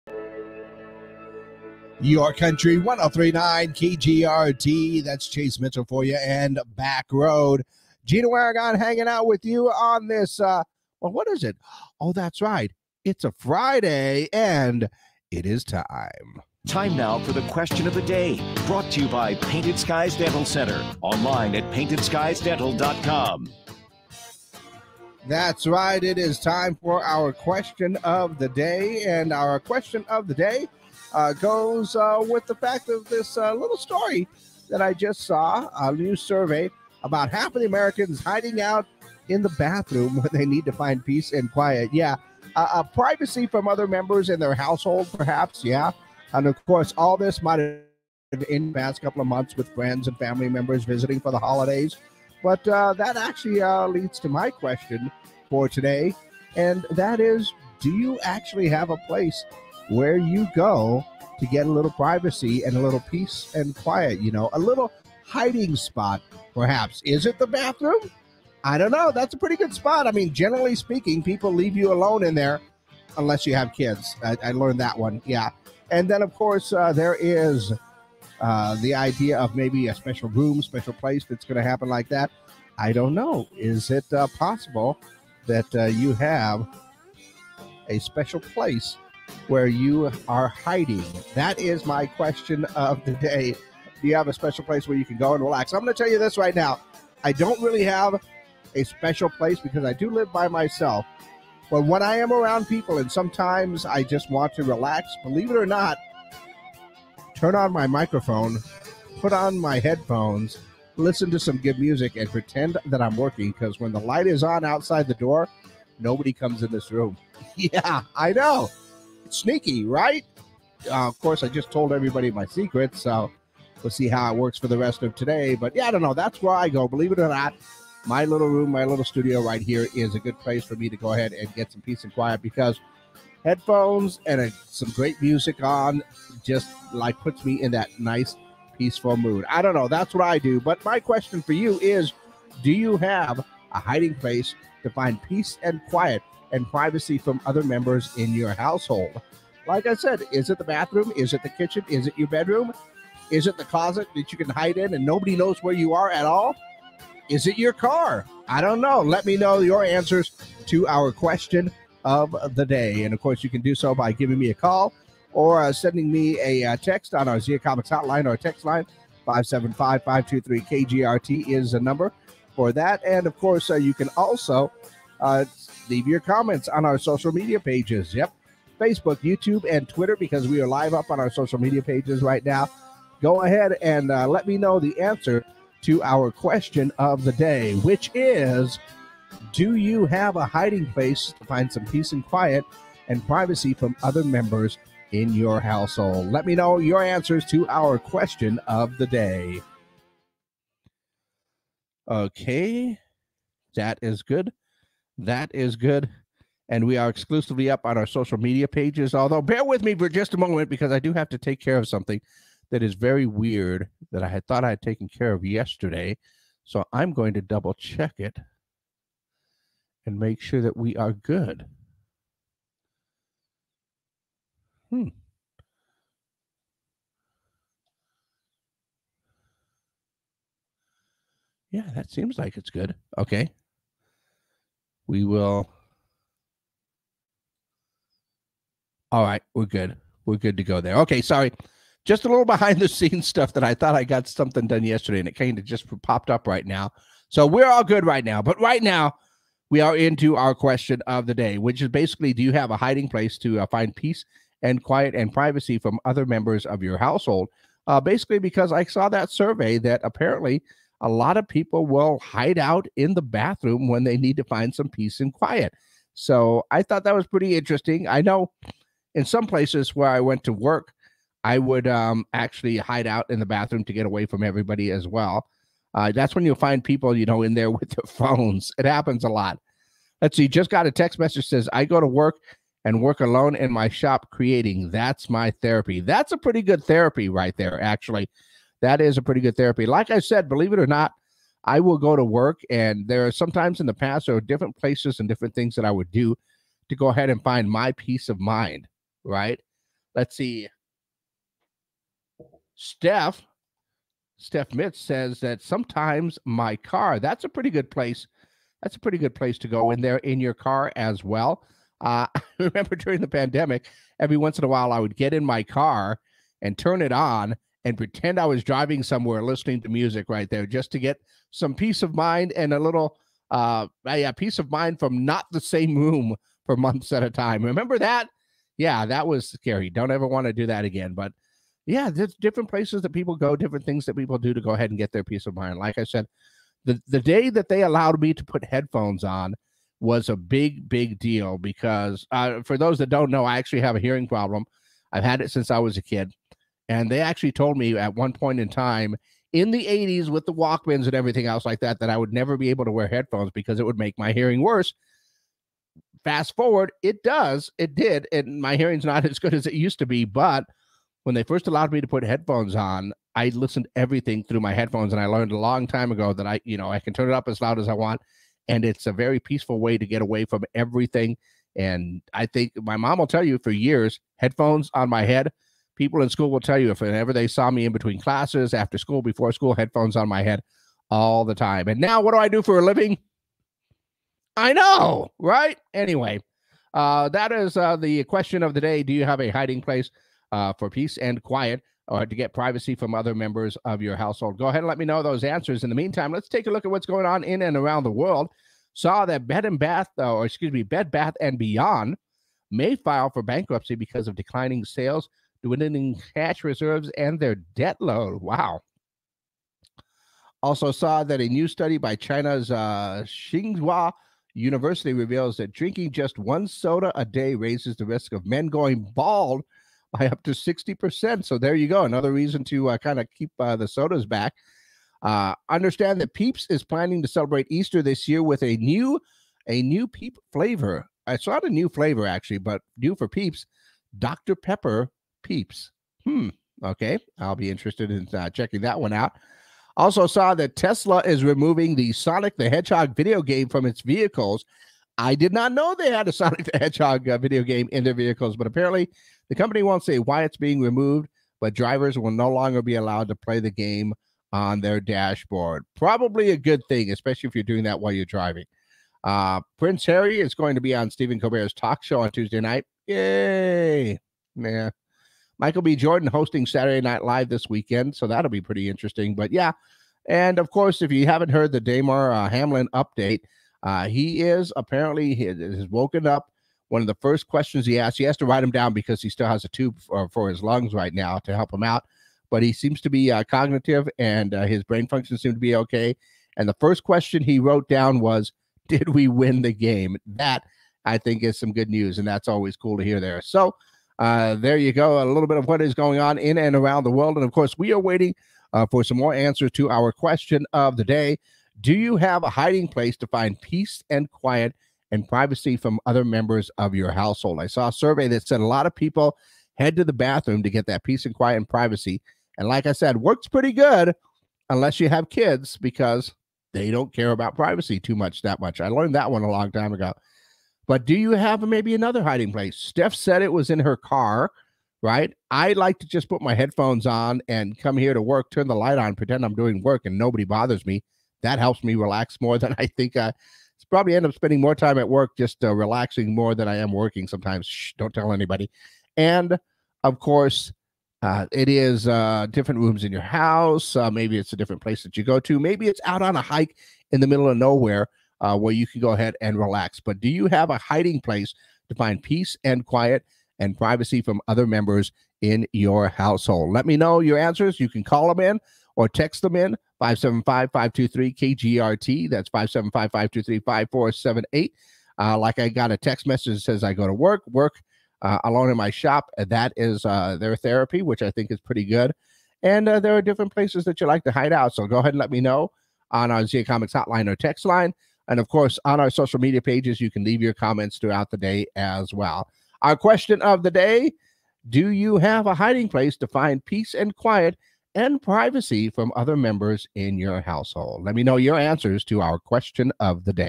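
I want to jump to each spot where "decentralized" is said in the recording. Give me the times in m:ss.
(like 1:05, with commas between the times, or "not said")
not said.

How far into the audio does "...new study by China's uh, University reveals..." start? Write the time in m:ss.
6:51.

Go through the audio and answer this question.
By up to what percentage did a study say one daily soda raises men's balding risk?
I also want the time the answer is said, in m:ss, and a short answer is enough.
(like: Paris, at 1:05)
60%, at 7:00.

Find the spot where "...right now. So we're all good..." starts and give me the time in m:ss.
4:06.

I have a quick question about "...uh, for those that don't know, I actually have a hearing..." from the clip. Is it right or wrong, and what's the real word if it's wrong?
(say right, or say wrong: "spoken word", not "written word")
right.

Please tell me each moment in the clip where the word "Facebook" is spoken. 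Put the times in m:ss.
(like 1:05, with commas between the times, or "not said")
2:58.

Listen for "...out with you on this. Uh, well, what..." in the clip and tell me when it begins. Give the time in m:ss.
0:09.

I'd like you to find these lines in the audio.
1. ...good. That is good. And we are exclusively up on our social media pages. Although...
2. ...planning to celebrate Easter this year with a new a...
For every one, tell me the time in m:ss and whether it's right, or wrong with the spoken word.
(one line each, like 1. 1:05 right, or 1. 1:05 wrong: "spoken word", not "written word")
1. 3:24 right
2. 7:06 right.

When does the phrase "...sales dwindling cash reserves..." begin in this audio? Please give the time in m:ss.
6:44.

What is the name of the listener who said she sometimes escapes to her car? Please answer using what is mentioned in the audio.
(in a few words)
Steph Mitz.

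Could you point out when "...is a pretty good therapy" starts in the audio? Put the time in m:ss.
4:48.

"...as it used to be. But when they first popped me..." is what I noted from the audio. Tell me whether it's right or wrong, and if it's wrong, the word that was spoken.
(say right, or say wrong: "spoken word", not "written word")
wrong: "allowed", not "popped".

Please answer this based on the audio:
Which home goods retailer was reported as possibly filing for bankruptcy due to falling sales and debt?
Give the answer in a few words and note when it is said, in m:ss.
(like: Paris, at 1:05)
Bed Bath and Beyond, at 6:40.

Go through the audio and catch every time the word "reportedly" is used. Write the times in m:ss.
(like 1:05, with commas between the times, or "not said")
not said.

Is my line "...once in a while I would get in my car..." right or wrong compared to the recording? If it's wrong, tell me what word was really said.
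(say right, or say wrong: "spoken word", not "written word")
right.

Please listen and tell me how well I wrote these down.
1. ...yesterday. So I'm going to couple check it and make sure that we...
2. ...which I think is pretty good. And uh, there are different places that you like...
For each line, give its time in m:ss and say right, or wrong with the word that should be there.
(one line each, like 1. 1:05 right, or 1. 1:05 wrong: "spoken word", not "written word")
1. 3:35 wrong: "double", not "couple"
2. 9:31 right.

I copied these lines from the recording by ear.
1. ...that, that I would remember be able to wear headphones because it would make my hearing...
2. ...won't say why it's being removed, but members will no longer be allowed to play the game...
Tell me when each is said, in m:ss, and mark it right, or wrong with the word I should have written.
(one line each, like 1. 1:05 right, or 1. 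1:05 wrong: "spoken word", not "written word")
1. 5:51 wrong: "never", not "remember"
2. 7:29 wrong: "drivers", not "members".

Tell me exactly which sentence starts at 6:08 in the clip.
And it's a very peaceful way to get away from everything.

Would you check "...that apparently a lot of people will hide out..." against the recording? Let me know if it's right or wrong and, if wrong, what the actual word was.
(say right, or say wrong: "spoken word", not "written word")
right.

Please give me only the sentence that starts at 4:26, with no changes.
So I thought that was pretty interesting.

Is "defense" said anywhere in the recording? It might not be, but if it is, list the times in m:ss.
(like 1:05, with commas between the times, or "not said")
not said.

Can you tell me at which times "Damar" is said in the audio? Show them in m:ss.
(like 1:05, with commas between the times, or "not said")
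7:51.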